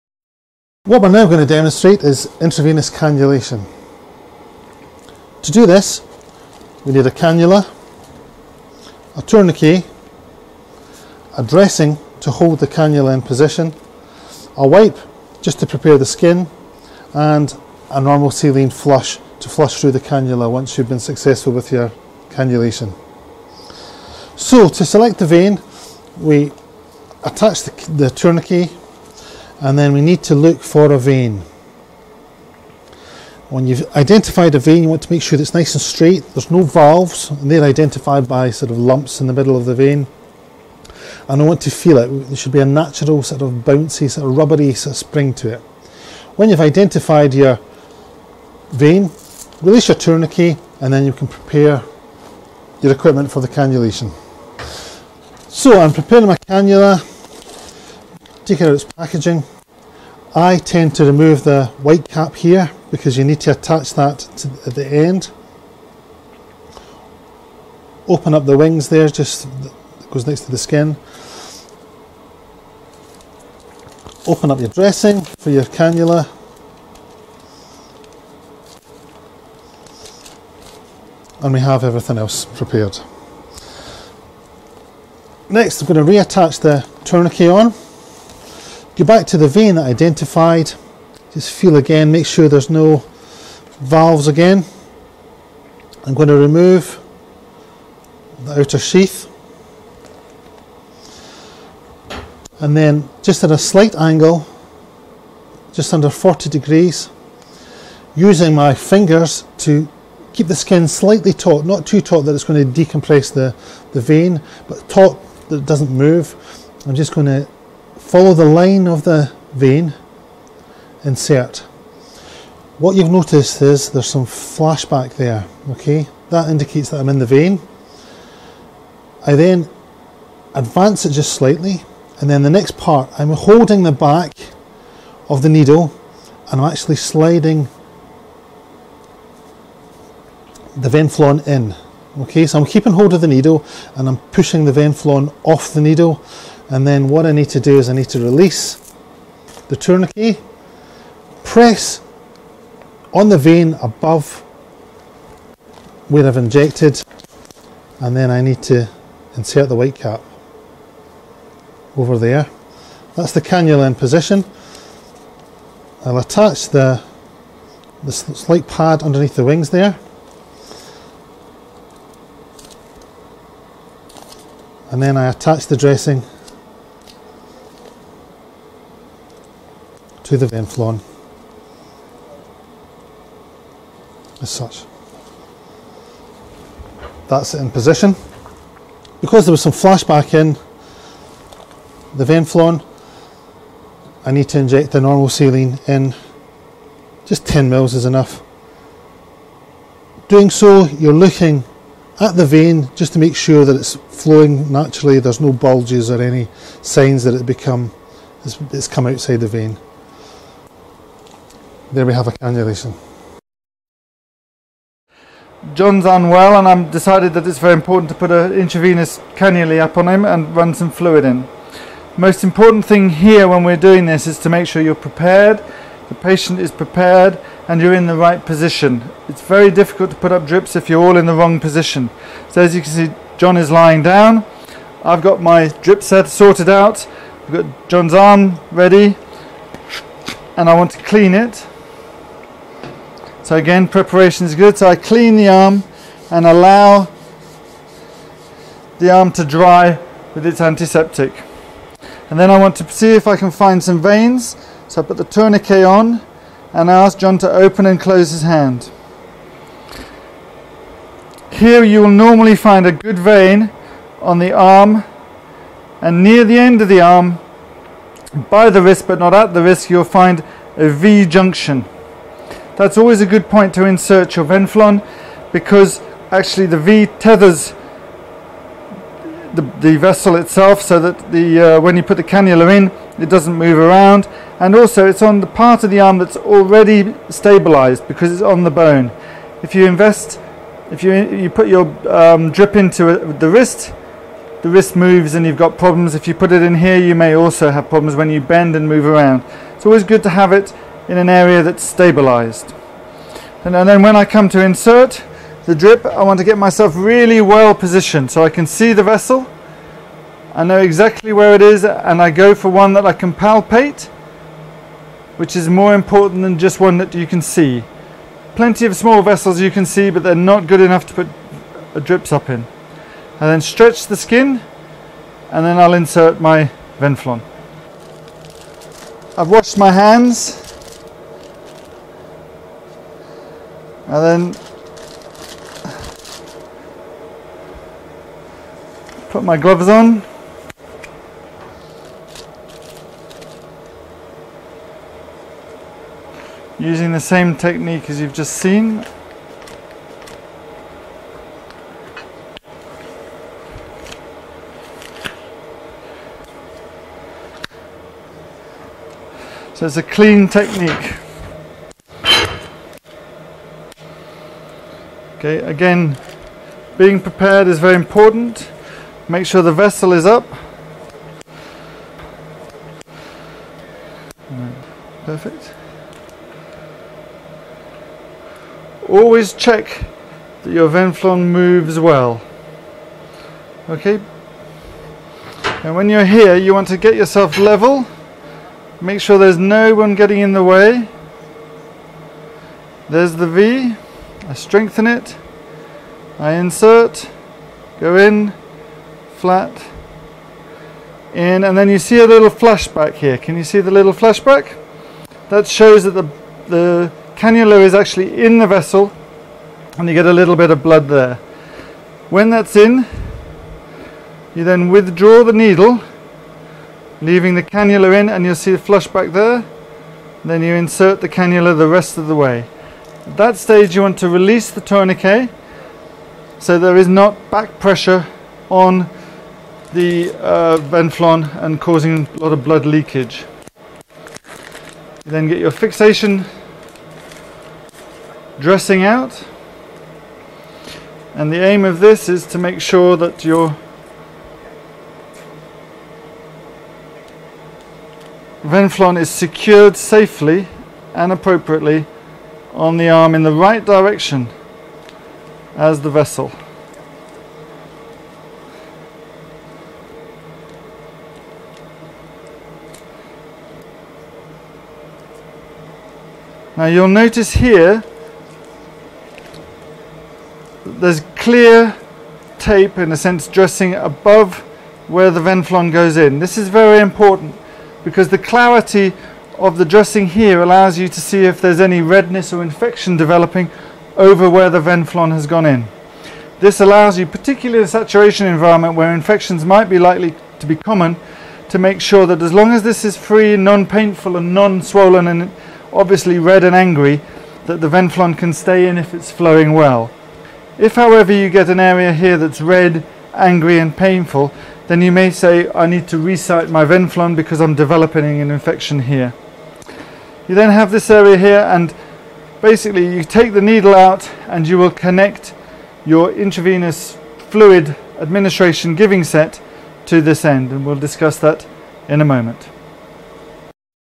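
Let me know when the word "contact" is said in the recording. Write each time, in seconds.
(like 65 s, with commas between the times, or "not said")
not said.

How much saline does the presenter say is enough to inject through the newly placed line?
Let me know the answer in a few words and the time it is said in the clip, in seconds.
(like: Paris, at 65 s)
10 mils, at 197 s.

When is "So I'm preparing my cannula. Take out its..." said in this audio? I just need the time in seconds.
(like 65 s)
55 s.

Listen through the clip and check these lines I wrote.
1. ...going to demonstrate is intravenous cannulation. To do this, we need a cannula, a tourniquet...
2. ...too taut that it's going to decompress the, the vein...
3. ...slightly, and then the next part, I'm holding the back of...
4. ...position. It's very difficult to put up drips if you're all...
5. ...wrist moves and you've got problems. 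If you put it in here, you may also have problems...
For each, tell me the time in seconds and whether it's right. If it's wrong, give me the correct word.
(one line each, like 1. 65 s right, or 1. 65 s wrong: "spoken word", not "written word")
1. 1 s right
2. 111 s right
3. 131 s right
4. 228 s right
5. 294 s right.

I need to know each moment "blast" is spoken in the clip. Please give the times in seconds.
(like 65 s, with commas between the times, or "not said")
not said.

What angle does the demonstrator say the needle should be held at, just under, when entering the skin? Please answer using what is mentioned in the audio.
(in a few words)
40 degrees.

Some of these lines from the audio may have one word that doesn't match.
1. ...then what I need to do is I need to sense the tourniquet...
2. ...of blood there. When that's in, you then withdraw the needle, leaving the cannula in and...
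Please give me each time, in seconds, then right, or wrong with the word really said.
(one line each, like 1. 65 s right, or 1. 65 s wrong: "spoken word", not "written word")
1. 146 s wrong: "release", not "sense"
2. 410 s right.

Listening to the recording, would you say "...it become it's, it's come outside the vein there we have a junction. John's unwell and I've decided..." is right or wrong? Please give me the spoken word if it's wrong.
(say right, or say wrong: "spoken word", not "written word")
wrong: "cannulation", not "junction".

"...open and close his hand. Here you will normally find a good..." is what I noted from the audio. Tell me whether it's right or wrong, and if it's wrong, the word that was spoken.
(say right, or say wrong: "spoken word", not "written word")
right.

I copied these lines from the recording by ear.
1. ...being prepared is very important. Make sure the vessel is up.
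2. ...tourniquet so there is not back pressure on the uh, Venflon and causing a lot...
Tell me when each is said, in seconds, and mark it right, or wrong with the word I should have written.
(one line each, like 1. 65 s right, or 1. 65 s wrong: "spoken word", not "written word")
1. 366 s right
2. 424 s right.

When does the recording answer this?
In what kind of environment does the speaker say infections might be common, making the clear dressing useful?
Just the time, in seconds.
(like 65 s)
487 s.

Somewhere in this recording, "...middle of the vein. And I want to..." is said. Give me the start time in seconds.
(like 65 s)
39 s.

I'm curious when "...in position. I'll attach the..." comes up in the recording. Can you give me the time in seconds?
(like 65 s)
163 s.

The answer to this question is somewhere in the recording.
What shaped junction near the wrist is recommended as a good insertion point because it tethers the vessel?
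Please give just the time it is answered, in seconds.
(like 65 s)
270 s.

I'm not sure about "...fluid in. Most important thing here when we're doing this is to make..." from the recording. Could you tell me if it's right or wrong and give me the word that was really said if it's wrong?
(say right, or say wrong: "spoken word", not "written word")
right.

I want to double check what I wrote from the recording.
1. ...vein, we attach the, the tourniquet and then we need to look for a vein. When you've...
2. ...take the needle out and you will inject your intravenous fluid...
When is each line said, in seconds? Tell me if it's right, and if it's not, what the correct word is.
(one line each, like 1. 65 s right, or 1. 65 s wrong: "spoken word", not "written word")
1. 25 s right
2. 513 s wrong: "connect", not "inject".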